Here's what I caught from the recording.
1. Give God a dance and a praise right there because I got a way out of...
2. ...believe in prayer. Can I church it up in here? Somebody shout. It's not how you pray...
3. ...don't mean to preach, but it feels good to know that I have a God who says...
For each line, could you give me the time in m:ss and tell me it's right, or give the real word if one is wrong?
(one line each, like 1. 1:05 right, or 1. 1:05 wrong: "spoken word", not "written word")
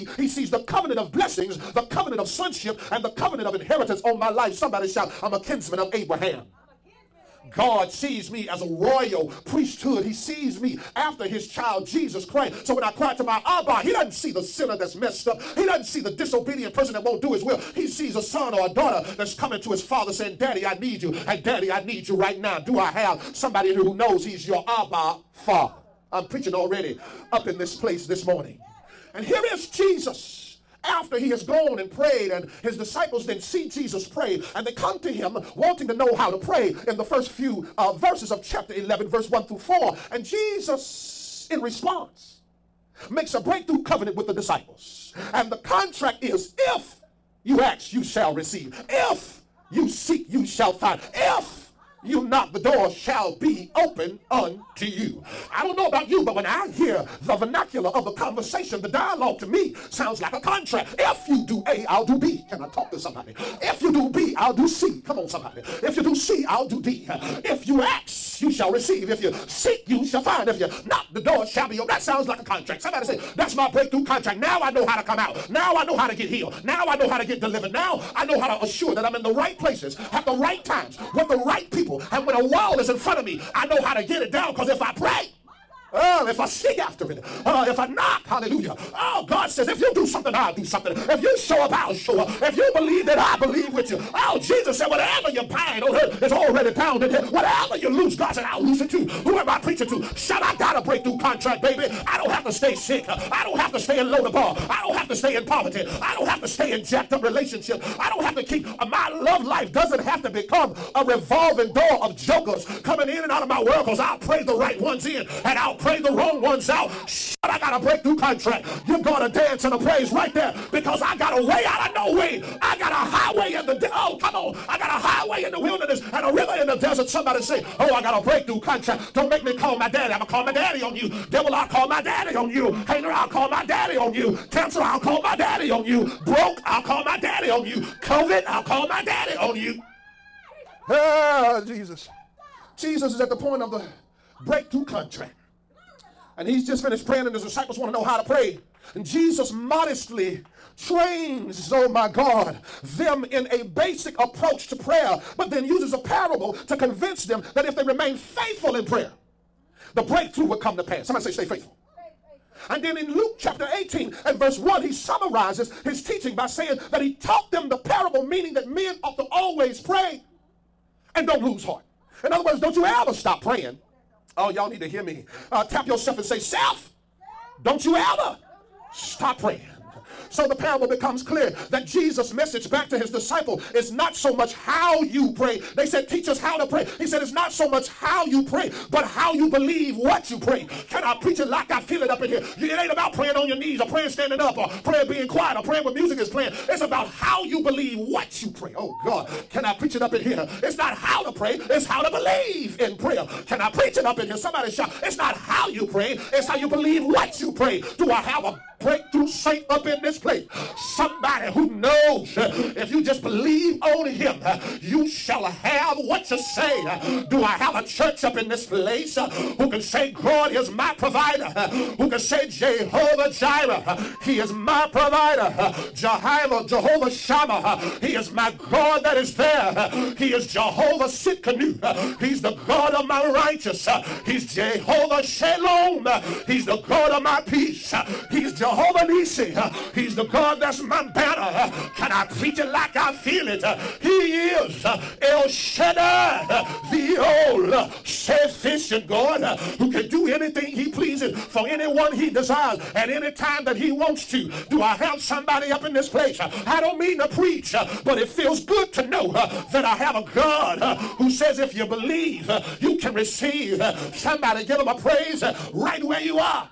1. 1:58 right
2. 3:22 wrong: "preach", not "church"
3. 4:16 right.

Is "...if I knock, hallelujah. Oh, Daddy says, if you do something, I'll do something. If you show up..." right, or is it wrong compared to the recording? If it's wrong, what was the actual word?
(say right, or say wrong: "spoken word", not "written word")
wrong: "God", not "Daddy".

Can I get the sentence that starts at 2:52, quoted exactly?
In other words, don't you ever stop praying.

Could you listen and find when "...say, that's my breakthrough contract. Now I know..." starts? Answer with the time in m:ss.
1:13.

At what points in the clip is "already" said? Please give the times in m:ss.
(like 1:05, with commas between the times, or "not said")
0:26, 1:36.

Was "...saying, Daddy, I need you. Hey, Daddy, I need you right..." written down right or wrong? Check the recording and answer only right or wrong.
right.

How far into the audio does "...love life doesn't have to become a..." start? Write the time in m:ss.
1:49.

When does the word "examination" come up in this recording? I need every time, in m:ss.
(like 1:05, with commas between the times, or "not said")
not said.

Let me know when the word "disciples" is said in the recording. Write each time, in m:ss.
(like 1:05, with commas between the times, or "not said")
0:32, 0:44, 2:27, 3:03.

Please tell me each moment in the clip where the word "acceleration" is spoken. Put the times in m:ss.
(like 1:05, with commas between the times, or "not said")
not said.